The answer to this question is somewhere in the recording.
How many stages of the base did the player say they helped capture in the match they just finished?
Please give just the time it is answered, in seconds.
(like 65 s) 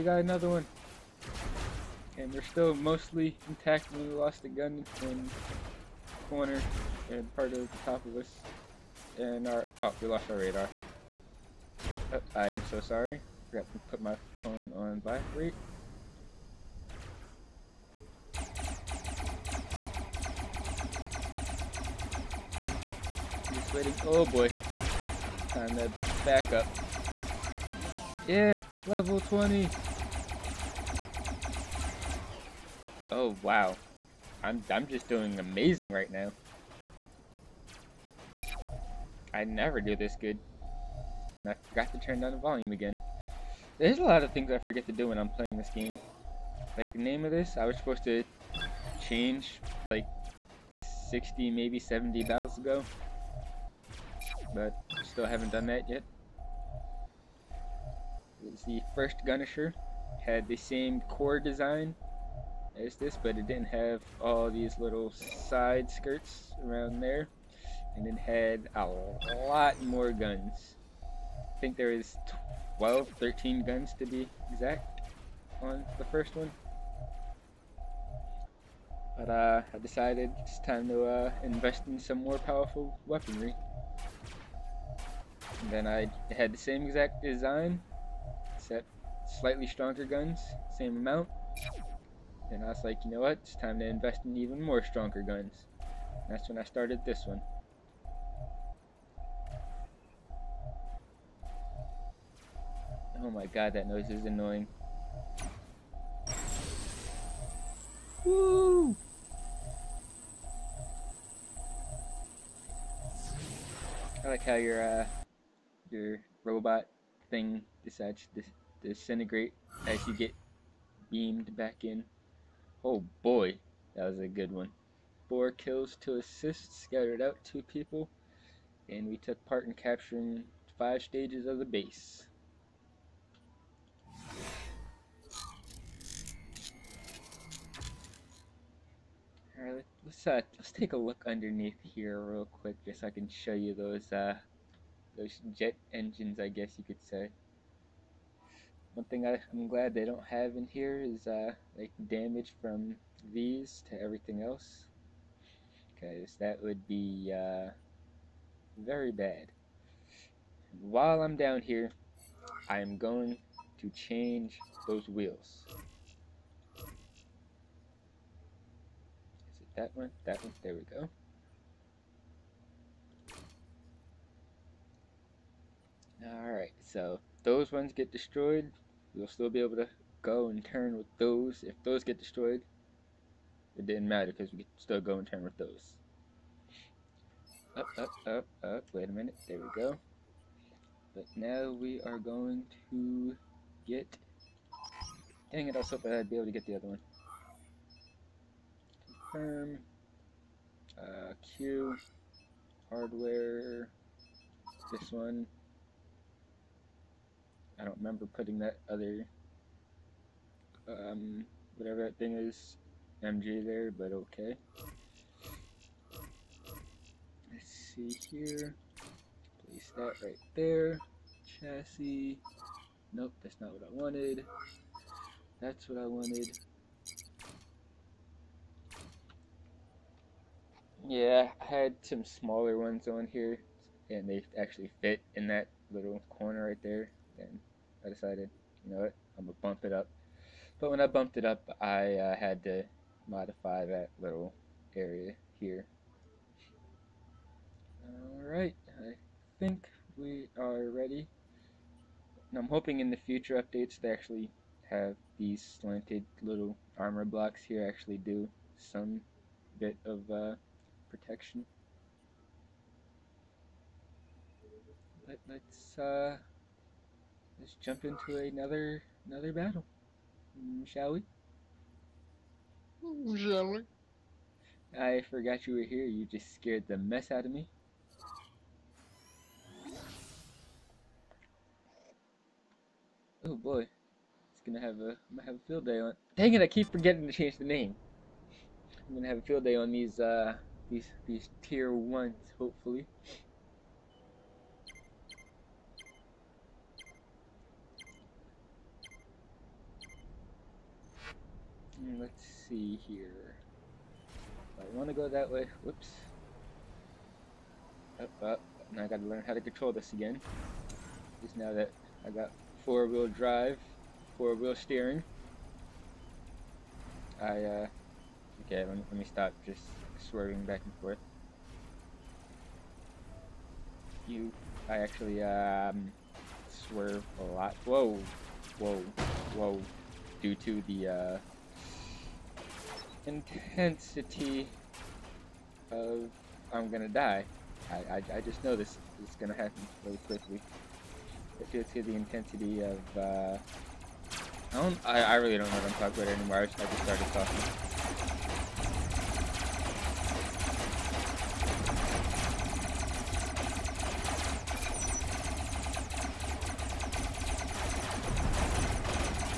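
130 s.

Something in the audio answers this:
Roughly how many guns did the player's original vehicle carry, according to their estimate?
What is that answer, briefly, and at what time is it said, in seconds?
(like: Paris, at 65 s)
12 or 13, at 72 s.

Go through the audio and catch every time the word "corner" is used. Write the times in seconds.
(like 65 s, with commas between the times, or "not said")
6 s, 236 s.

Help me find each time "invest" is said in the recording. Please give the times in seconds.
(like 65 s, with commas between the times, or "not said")
81 s, 93 s.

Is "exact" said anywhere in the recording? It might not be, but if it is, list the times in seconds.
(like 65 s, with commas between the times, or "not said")
74 s, 86 s.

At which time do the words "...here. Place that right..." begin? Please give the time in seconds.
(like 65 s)
218 s.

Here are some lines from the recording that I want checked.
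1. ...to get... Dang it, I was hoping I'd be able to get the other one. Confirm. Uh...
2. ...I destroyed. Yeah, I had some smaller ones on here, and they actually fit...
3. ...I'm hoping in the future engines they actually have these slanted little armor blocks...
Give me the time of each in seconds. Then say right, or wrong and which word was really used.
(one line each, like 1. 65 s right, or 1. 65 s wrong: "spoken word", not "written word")
1. 192 s right
2. 226 s wrong: "wanted", not "destroyed"
3. 252 s wrong: "updates", not "engines".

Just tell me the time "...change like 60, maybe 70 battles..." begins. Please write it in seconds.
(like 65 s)
49 s.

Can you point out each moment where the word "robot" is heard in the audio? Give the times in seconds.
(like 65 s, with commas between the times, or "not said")
116 s.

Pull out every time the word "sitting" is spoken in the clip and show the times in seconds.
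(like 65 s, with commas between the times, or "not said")
not said.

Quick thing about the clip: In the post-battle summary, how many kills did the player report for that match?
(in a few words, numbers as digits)
4.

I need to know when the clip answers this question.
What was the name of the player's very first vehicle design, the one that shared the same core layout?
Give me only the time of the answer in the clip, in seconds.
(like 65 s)
59 s.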